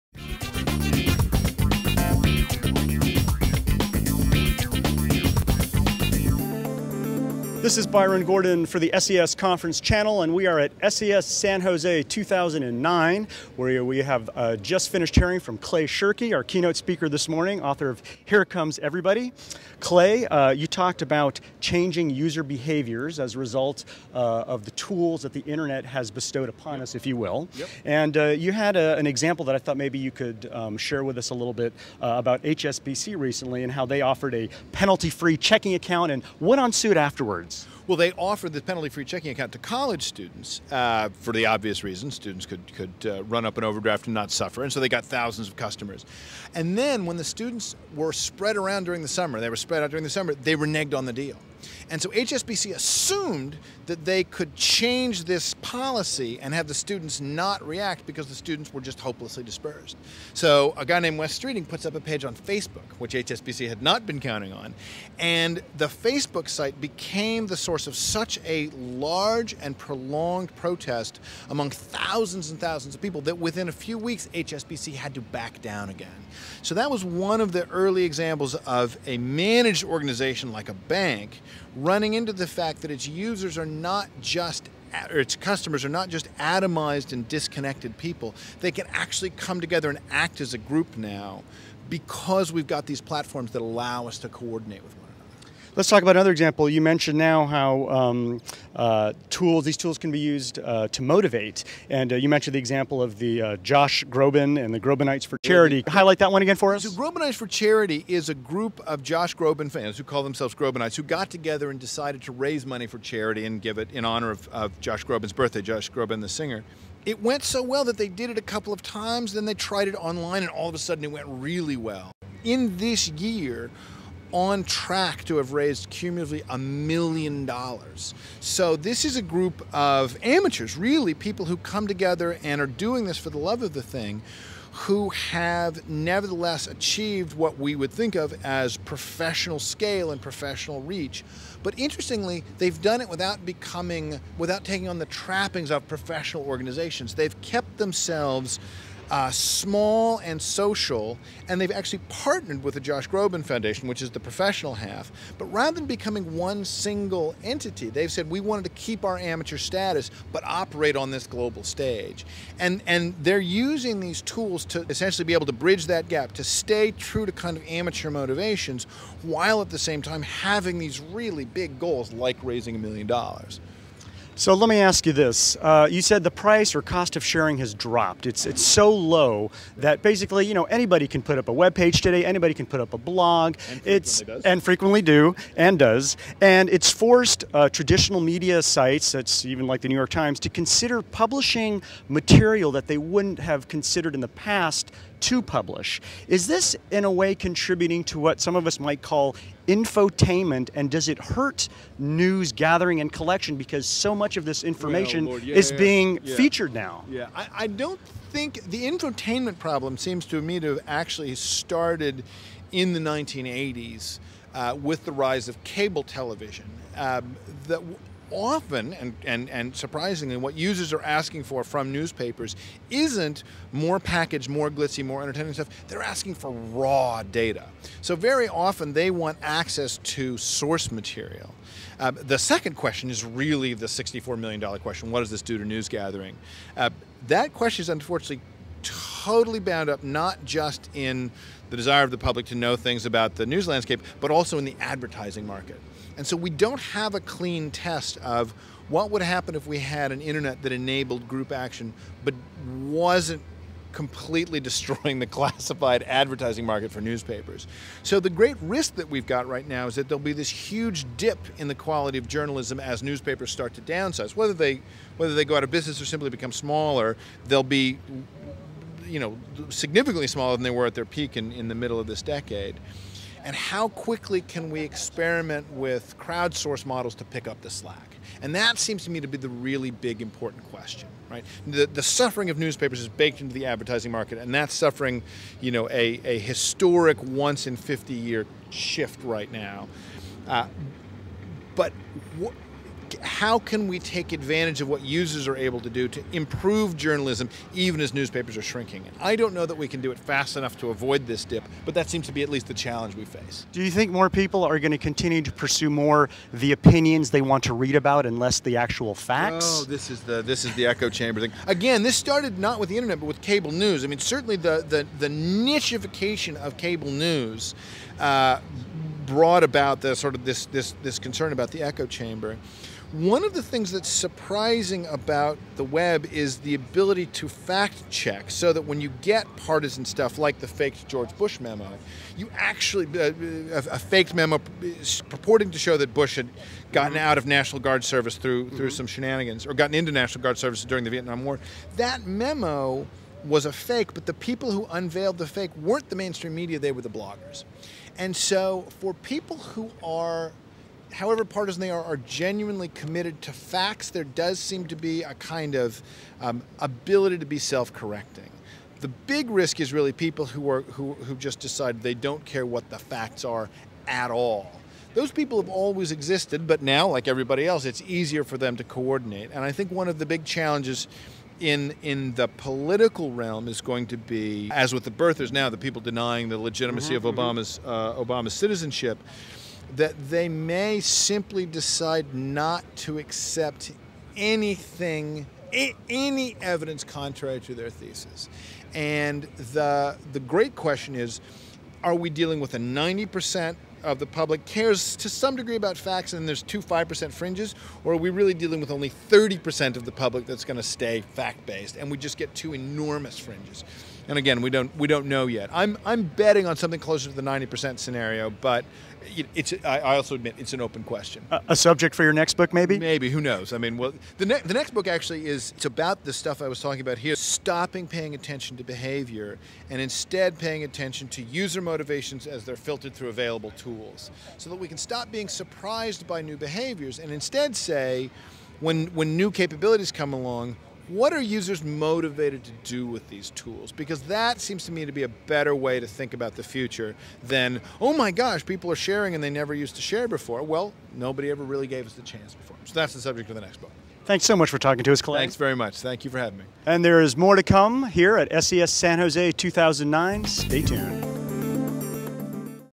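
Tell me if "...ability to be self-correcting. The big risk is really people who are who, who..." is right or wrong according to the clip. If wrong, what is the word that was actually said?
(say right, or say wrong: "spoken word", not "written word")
right.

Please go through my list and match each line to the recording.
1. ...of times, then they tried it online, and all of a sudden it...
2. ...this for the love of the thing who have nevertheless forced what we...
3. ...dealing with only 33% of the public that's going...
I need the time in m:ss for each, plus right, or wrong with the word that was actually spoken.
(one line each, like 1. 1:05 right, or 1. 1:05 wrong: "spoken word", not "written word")
1. 1:58 right
2. 2:13 wrong: "achieved", not "forced"
3. 6:38 wrong: "30", not "33".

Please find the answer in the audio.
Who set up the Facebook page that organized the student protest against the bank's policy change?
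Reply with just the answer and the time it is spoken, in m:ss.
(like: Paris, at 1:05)
Wes Streeting, at 1:01.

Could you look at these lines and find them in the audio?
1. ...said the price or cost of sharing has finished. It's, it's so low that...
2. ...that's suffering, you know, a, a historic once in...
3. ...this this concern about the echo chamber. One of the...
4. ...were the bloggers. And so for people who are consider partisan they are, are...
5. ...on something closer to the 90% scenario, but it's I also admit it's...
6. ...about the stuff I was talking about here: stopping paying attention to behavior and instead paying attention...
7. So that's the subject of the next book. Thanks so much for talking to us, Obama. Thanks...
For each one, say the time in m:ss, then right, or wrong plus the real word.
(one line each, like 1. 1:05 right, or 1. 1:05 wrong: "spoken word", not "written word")
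1. 2:56 wrong: "dropped", not "finished"
2. 4:44 right
3. 5:20 right
4. 5:46 wrong: "however", not "consider"
5. 6:46 right
6. 6:55 right
7. 7:22 wrong: "Clay", not "Obama".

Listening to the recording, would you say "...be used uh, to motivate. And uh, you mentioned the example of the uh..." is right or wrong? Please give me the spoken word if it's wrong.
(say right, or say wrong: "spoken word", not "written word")
right.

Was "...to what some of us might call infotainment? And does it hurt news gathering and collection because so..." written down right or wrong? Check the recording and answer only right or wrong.
right.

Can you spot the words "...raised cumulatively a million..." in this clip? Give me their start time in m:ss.
2:05.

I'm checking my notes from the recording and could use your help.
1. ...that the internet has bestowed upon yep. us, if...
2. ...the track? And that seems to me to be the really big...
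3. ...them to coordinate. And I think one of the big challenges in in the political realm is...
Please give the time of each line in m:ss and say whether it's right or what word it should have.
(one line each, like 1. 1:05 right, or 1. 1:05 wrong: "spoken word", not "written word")
1. 0:25 right
2. 4:37 wrong: "slack", not "track"
3. 6:08 right.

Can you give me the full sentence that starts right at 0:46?
And then when the students were spread around during the summer, they were spread out during the summer.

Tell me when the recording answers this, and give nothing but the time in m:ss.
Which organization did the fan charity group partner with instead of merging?
2:32.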